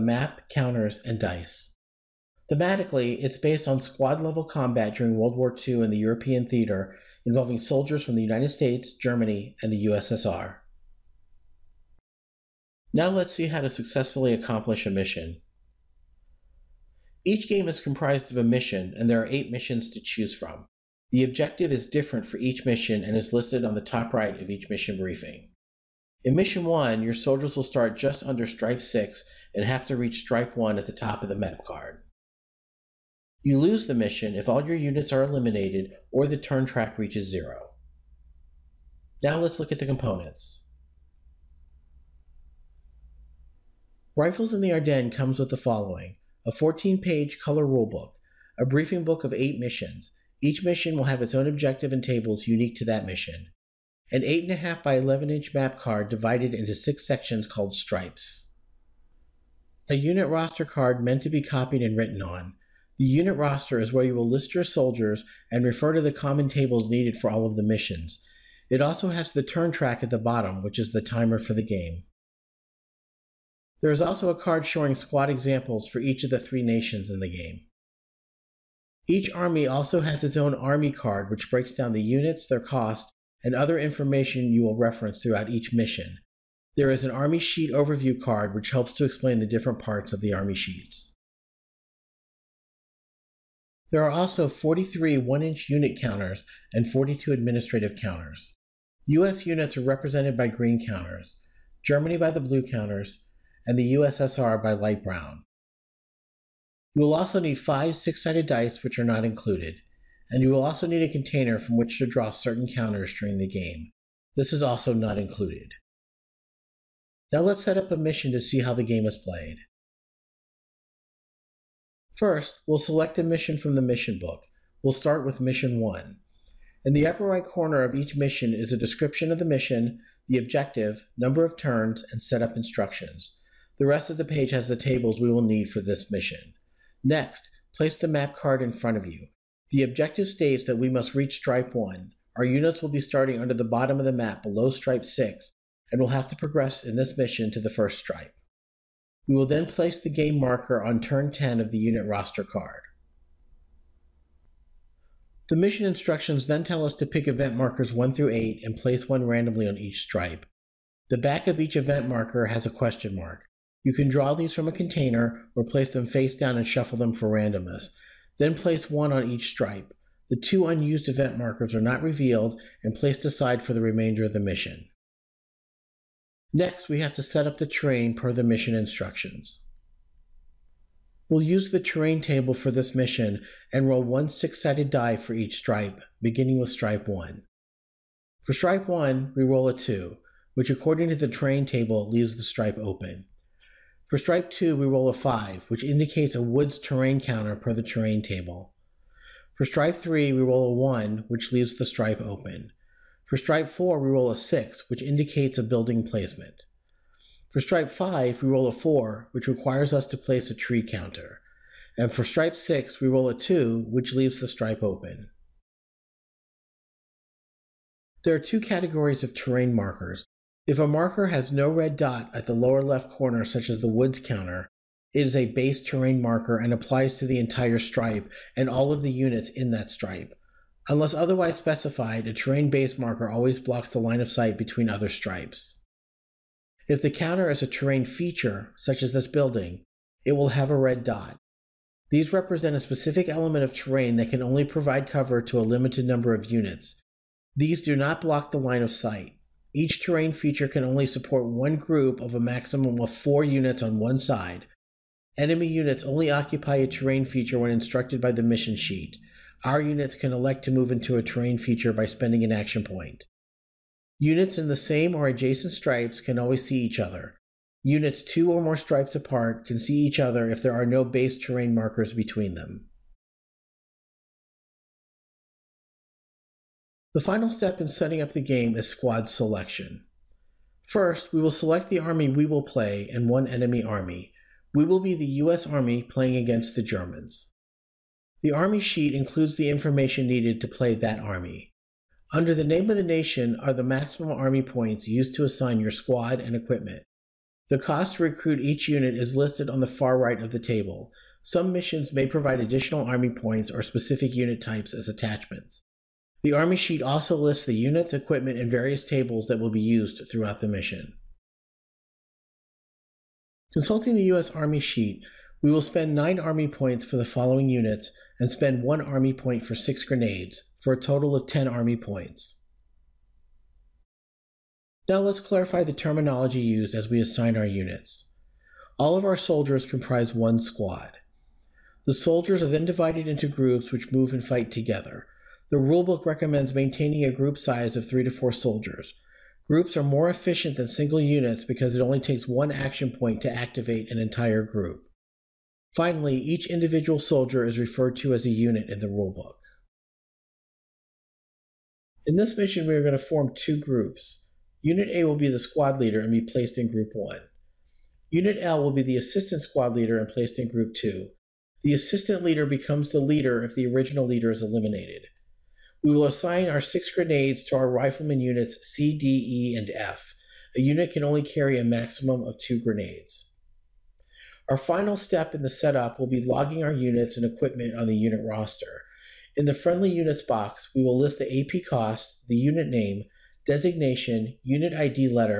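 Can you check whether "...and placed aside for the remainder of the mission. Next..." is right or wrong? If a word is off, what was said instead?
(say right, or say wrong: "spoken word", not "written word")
right.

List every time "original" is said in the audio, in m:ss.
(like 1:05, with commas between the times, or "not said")
6:03.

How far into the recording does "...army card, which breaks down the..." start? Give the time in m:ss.
1:20.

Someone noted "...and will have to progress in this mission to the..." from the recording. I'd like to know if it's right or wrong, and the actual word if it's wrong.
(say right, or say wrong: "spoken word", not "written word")
right.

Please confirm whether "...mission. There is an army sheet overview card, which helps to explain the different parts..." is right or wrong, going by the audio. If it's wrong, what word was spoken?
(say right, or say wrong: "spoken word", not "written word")
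right.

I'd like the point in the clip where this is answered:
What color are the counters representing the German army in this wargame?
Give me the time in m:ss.
1:42.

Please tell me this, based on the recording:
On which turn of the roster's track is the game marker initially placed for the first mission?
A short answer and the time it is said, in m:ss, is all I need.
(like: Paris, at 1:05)
10, at 2:30.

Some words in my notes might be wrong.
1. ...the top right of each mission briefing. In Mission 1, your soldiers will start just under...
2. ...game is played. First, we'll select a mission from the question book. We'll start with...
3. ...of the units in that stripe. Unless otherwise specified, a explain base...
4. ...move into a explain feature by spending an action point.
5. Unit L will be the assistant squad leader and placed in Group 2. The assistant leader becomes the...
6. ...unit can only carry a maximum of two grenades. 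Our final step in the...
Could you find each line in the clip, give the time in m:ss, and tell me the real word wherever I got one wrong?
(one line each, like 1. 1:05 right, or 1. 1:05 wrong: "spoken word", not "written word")
1. 0:23 right
2. 1:58 wrong: "mission", not "question"
3. 3:48 wrong: "terrain", not "explain"
4. 4:20 wrong: "terrain", not "explain"
5. 5:58 right
6. 6:10 right.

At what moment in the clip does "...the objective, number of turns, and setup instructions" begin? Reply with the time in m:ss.
2:10.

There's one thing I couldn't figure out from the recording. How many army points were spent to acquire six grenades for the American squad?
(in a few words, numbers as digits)
1.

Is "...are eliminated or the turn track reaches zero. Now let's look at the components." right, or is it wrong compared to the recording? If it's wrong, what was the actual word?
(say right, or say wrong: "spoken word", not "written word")
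right.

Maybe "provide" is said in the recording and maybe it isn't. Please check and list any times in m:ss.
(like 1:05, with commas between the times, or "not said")
4:04, 5:02.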